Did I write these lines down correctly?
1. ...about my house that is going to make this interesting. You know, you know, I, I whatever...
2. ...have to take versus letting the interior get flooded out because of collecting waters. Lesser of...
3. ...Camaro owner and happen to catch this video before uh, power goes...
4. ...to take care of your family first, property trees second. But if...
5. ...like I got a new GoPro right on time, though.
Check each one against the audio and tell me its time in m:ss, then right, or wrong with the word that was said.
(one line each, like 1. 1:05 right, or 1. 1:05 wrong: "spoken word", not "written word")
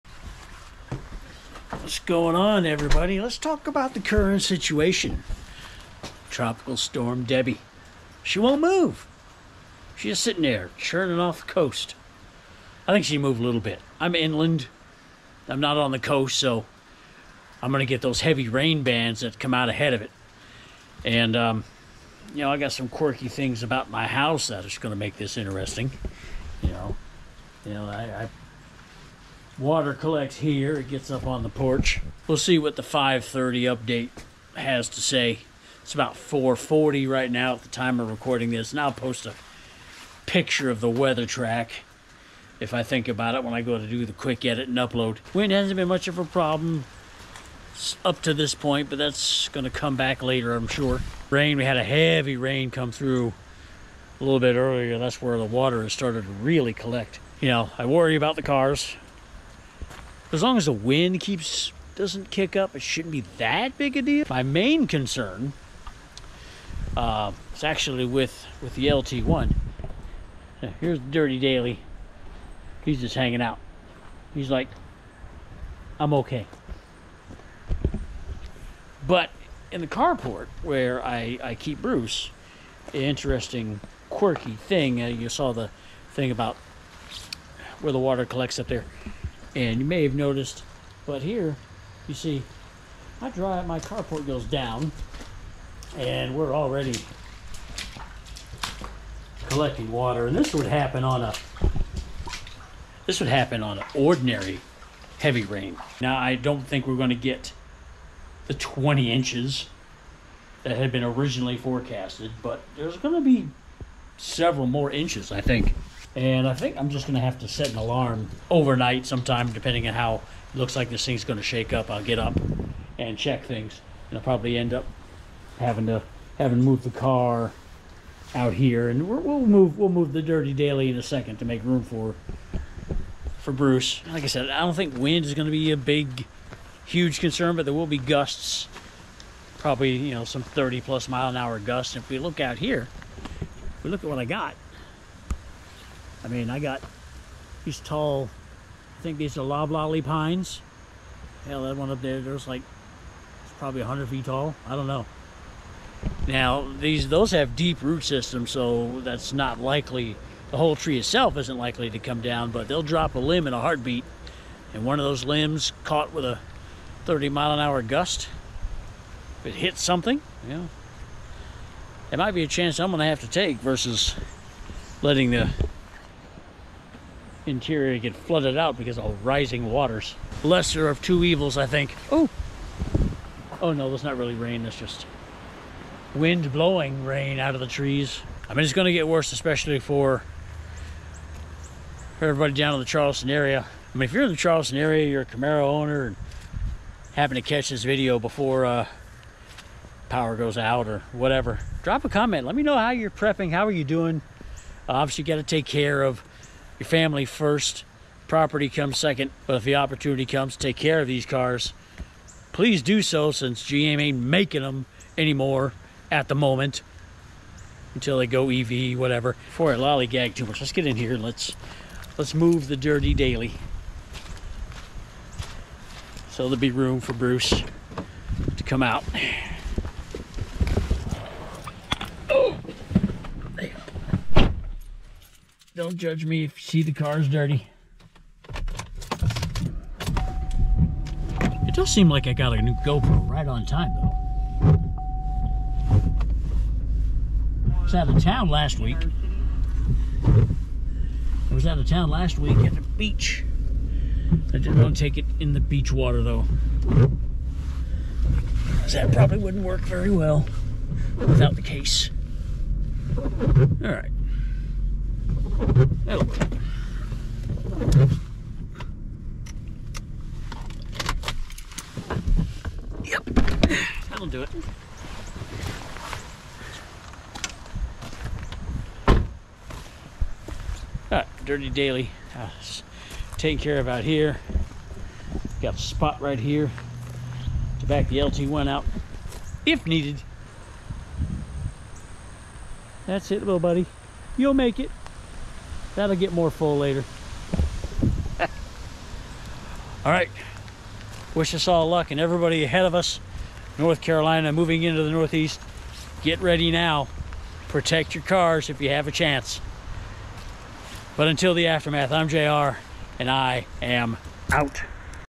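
1. 0:23 wrong: "water", not "whatever"
2. 2:53 wrong: "rising", not "collecting"
3. 3:15 right
4. 3:25 wrong: "comes", not "trees"
5. 4:02 right.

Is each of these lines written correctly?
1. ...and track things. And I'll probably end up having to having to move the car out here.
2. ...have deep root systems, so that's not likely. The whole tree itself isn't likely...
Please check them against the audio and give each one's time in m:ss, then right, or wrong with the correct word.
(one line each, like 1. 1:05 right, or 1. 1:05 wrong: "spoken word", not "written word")
1. 2:02 wrong: "check", not "track"
2. 2:37 right.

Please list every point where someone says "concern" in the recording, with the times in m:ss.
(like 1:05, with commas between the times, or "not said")
1:04, 2:17.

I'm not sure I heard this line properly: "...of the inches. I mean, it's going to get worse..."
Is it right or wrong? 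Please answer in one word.
wrong.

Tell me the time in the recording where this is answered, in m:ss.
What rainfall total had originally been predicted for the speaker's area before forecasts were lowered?
1:48.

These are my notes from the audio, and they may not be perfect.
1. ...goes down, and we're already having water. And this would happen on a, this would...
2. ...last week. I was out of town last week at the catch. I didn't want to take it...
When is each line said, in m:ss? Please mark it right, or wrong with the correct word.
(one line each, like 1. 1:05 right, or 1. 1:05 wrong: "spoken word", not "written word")
1. 1:34 wrong: "collecting", not "having"
2. 4:08 wrong: "beach", not "catch".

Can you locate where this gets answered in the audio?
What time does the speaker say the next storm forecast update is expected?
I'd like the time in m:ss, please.
0:32.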